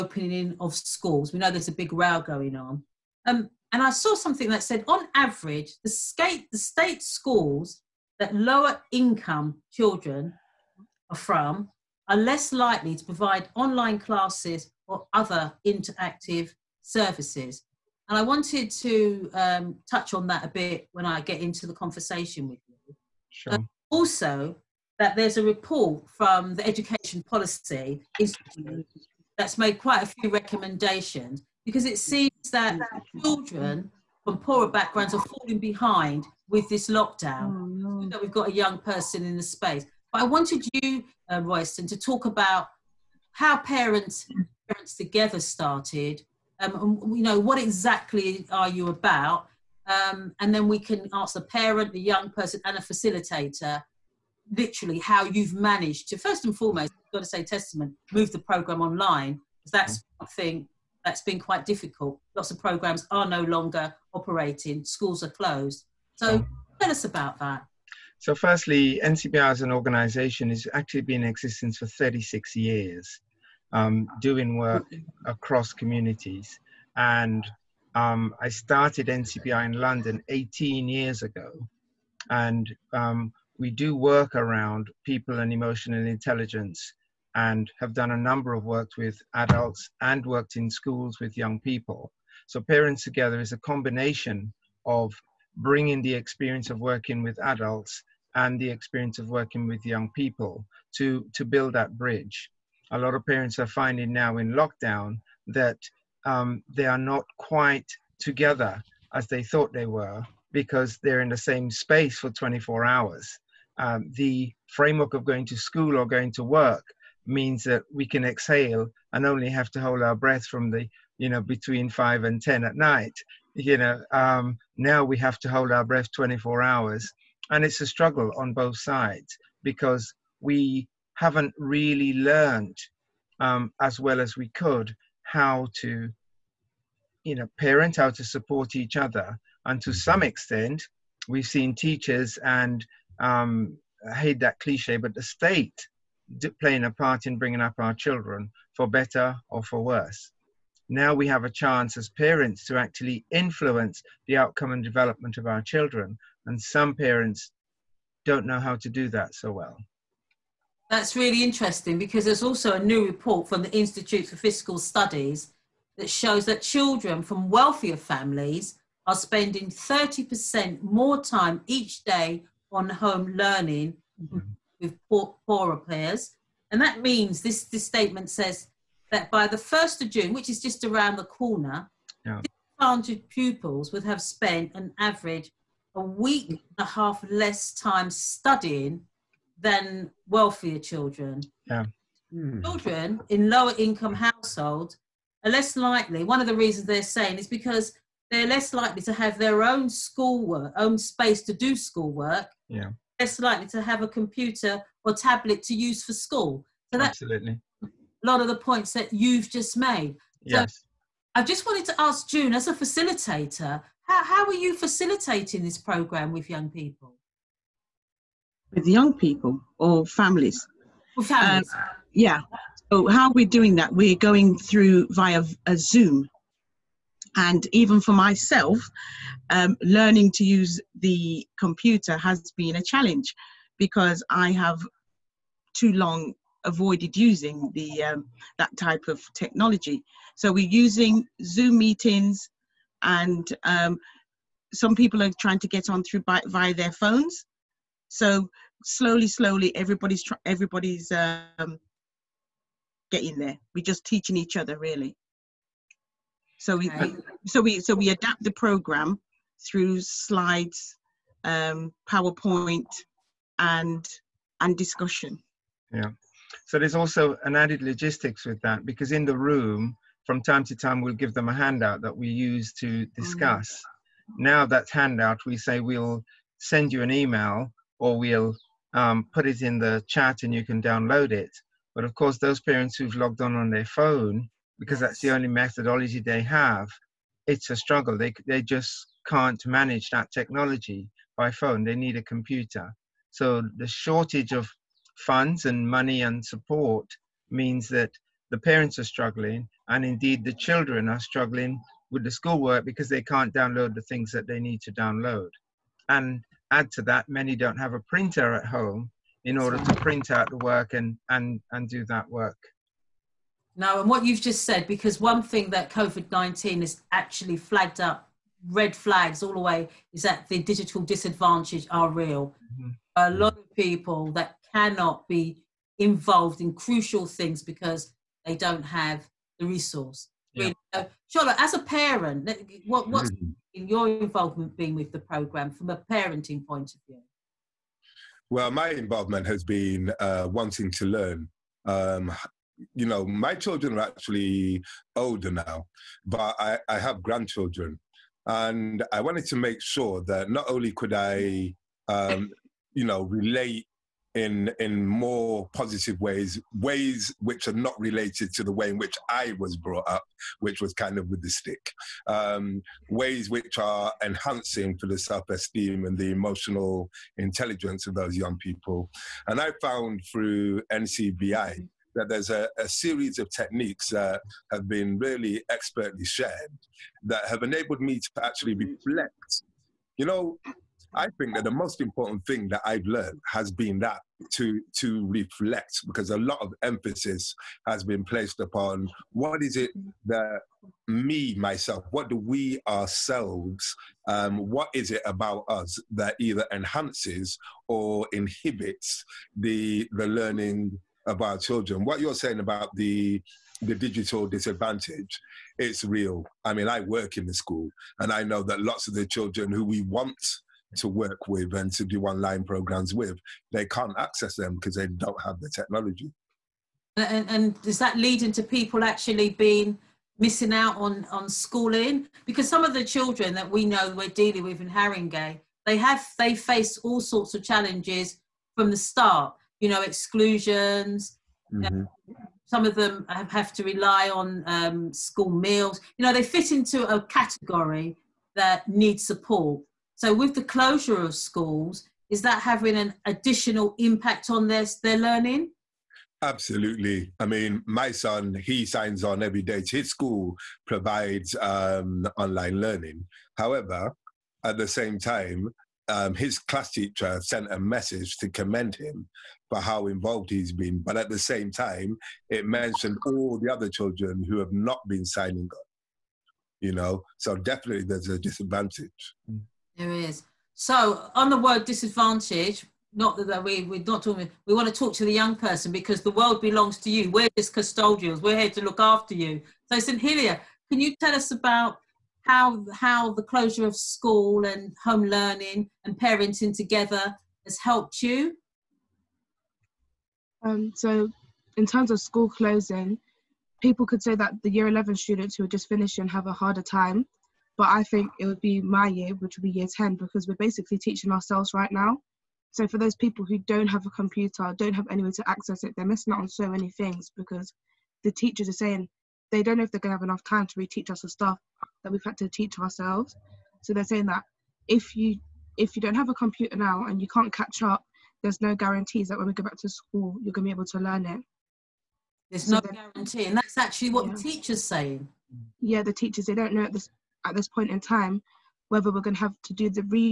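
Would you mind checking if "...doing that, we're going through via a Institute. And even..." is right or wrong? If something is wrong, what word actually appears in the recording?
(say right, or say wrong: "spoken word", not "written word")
wrong: "Zoom", not "Institute".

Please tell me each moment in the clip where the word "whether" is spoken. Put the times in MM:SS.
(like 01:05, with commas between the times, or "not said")
08:48.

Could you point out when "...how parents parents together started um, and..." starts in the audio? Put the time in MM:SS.
00:43.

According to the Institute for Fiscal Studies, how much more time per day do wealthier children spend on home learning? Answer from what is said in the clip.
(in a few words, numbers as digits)
30%.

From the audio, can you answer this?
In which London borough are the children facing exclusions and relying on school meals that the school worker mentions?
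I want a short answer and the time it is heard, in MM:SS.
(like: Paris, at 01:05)
Haringey, at 07:04.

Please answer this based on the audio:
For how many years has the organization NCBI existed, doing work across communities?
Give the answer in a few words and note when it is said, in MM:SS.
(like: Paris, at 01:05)
36, at 01:11.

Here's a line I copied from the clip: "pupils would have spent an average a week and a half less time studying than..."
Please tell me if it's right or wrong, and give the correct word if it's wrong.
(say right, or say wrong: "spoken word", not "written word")
right.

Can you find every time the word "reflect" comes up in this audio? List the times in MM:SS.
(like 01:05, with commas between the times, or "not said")
06:18, 06:25.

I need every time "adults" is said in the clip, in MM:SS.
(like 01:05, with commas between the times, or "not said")
01:29, 01:37.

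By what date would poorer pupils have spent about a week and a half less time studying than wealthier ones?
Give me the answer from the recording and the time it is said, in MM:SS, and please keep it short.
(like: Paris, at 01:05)
1st of June, at 02:59.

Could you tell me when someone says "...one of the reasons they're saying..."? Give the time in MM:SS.
03:16.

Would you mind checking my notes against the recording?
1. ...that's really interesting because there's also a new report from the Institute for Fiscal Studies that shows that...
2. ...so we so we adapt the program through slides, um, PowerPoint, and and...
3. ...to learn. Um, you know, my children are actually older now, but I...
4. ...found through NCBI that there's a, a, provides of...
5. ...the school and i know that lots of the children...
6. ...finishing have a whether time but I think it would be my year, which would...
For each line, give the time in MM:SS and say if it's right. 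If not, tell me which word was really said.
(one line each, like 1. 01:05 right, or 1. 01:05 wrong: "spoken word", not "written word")
1. 02:40 right
2. 04:17 right
3. 05:40 right
4. 06:09 wrong: "series", not "provides"
5. 06:47 right
6. 08:15 wrong: "harder", not "whether".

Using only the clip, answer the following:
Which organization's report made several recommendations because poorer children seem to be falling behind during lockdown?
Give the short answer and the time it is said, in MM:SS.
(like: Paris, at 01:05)
Education Policy Institute, at 00:26.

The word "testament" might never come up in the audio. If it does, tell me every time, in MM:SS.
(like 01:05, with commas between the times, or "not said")
00:57.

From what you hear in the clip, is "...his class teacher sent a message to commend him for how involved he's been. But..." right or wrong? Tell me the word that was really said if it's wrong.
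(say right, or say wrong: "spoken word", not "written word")
right.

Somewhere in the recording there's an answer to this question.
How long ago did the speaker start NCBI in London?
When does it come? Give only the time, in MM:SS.
01:20.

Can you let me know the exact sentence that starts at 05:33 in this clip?
your involvement been with the program from a parenting point of view?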